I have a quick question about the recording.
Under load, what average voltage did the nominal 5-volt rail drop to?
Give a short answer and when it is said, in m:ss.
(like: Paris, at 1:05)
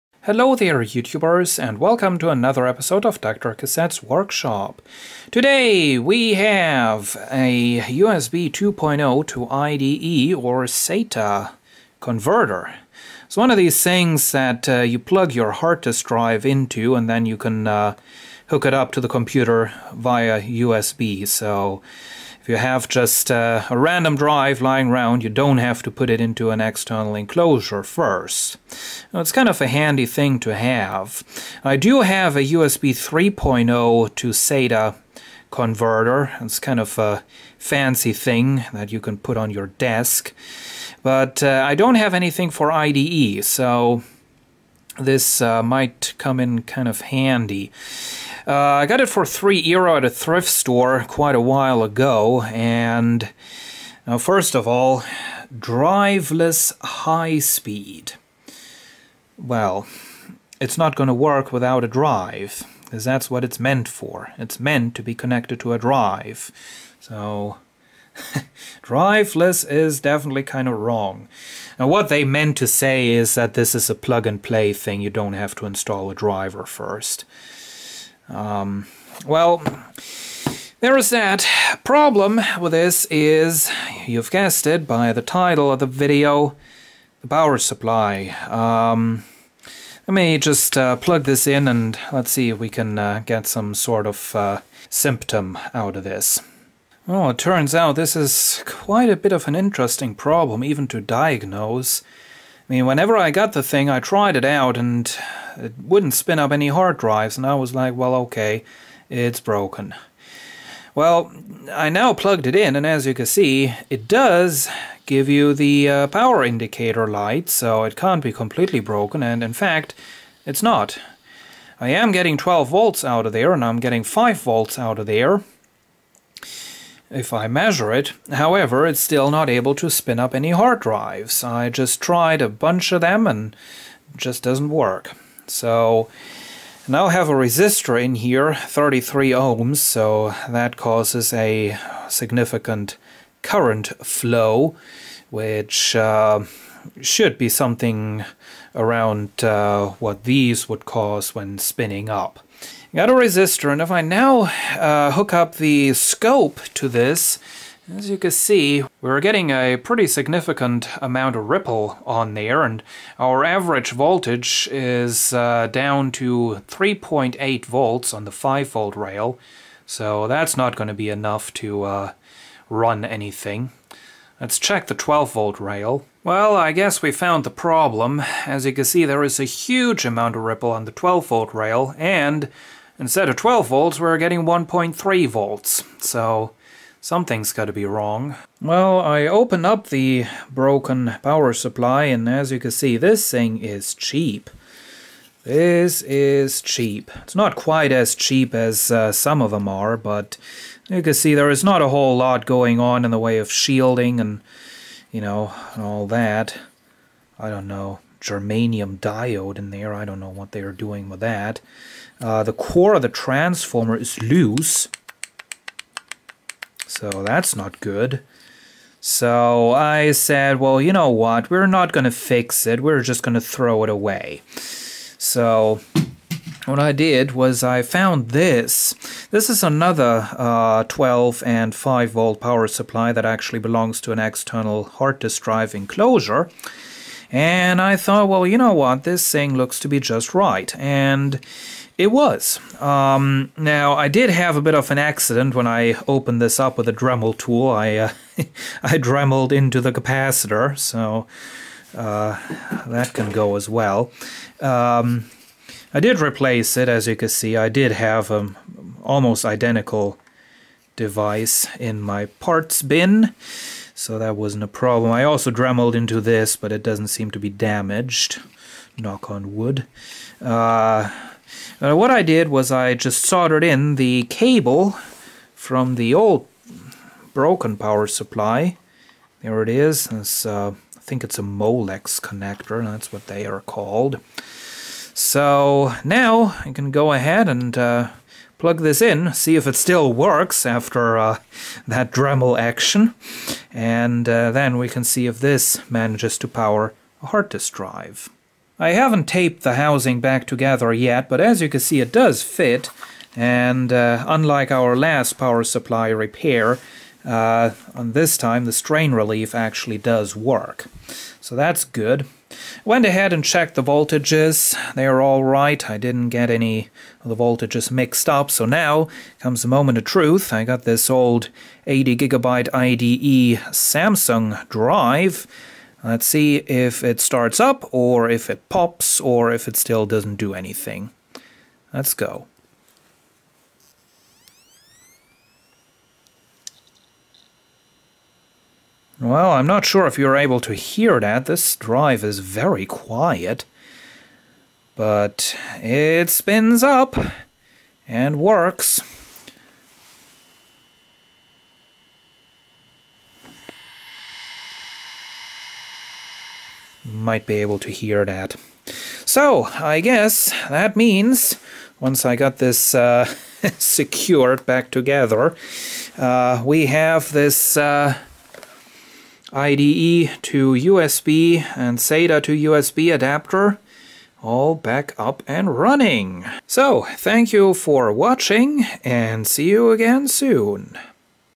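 3.8 volts, at 2:46.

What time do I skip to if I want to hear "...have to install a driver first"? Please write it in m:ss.
1:15.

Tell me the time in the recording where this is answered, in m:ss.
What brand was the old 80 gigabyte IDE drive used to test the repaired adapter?
5:23.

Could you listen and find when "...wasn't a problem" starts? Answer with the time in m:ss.
4:24.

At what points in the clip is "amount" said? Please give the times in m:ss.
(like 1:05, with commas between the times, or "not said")
2:41, 3:00.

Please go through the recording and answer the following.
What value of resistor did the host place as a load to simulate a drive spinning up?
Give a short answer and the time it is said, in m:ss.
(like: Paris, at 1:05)
33 ohms, at 2:18.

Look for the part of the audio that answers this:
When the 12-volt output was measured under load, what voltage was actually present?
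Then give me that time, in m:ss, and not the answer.
3:04.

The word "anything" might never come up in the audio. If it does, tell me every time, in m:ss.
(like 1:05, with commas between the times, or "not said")
0:42, 2:53, 5:30.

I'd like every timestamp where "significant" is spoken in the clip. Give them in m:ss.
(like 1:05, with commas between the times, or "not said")
2:22, 2:40.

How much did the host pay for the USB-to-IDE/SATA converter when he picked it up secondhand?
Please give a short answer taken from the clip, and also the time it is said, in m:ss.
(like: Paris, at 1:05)
3 euro, at 0:49.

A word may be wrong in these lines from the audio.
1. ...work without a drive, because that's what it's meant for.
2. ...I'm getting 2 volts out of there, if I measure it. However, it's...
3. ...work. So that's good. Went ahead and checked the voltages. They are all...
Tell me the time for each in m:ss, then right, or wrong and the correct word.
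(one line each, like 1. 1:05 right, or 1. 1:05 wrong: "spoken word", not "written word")
1. 1:01 right
2. 2:03 wrong: "5", not "2"
3. 5:10 right.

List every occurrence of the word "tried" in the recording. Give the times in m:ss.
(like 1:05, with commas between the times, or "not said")
1:43, 2:12.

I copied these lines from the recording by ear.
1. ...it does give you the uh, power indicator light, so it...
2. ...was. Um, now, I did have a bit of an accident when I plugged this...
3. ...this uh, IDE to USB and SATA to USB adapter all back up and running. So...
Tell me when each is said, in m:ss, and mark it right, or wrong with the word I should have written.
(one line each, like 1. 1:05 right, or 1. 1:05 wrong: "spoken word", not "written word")
1. 1:53 right
2. 4:02 wrong: "opened", not "plugged"
3. 6:07 right.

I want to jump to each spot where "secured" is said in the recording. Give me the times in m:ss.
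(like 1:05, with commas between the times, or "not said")
6:03.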